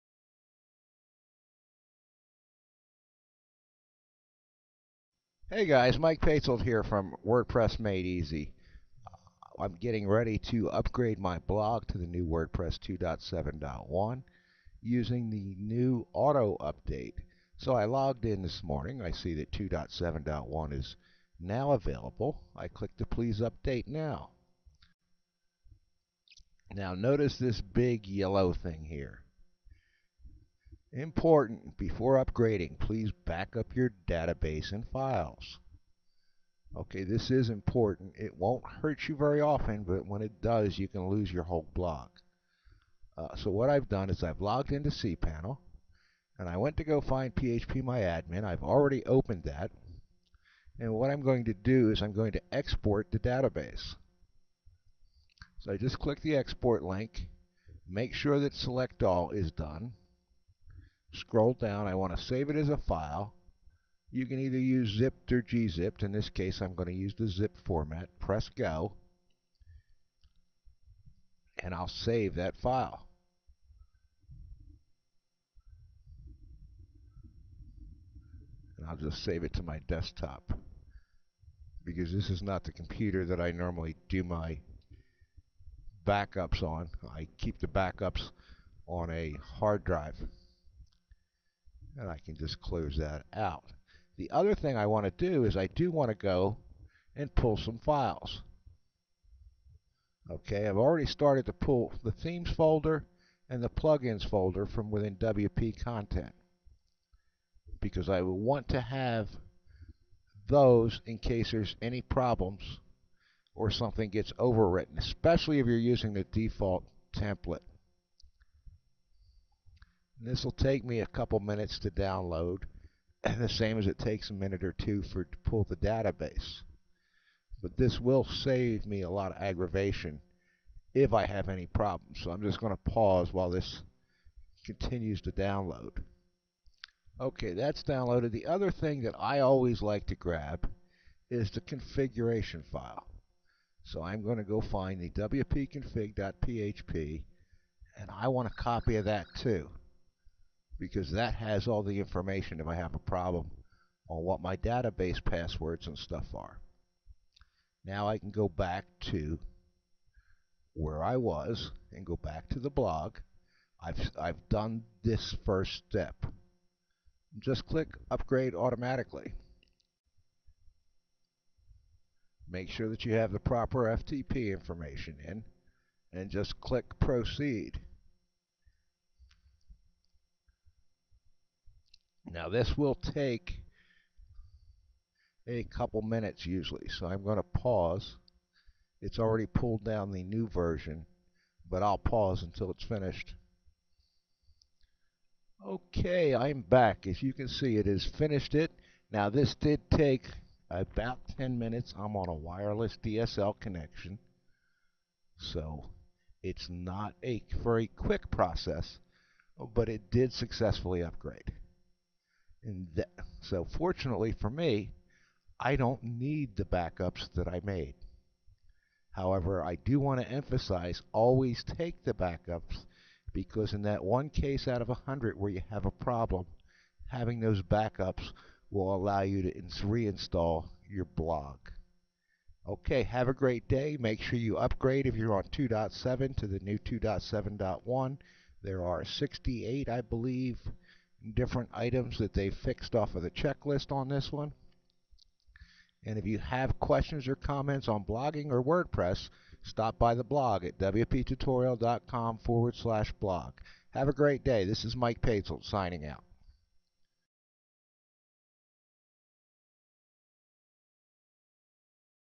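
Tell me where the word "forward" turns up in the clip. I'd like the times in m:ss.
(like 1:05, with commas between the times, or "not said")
4:12.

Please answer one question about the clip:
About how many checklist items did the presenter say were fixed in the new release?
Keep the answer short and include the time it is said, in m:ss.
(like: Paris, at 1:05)
68, at 3:59.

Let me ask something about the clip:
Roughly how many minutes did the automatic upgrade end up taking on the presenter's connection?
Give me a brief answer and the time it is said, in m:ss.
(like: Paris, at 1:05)
10, at 3:21.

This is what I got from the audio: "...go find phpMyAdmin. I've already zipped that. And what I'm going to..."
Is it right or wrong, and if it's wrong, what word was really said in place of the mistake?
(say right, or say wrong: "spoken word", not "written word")
wrong: "opened", not "zipped".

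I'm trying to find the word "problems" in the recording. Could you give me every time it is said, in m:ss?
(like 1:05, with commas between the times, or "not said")
1:52, 2:11, 2:32, 3:45.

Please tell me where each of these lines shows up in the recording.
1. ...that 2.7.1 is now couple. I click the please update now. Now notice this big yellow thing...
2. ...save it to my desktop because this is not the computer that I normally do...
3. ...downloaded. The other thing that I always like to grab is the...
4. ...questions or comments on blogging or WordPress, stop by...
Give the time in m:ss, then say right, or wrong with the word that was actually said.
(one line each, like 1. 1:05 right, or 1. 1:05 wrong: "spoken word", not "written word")
1. 0:19 wrong: "available", not "couple"
2. 1:19 right
3. 2:17 right
4. 4:06 right.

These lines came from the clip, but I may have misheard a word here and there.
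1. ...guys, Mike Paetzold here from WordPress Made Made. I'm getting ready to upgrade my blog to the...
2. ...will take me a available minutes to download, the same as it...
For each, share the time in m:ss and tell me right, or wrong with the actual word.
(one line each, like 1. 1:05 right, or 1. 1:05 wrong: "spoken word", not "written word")
1. 0:05 wrong: "Easy", not "Made"
2. 2:00 wrong: "couple", not "available".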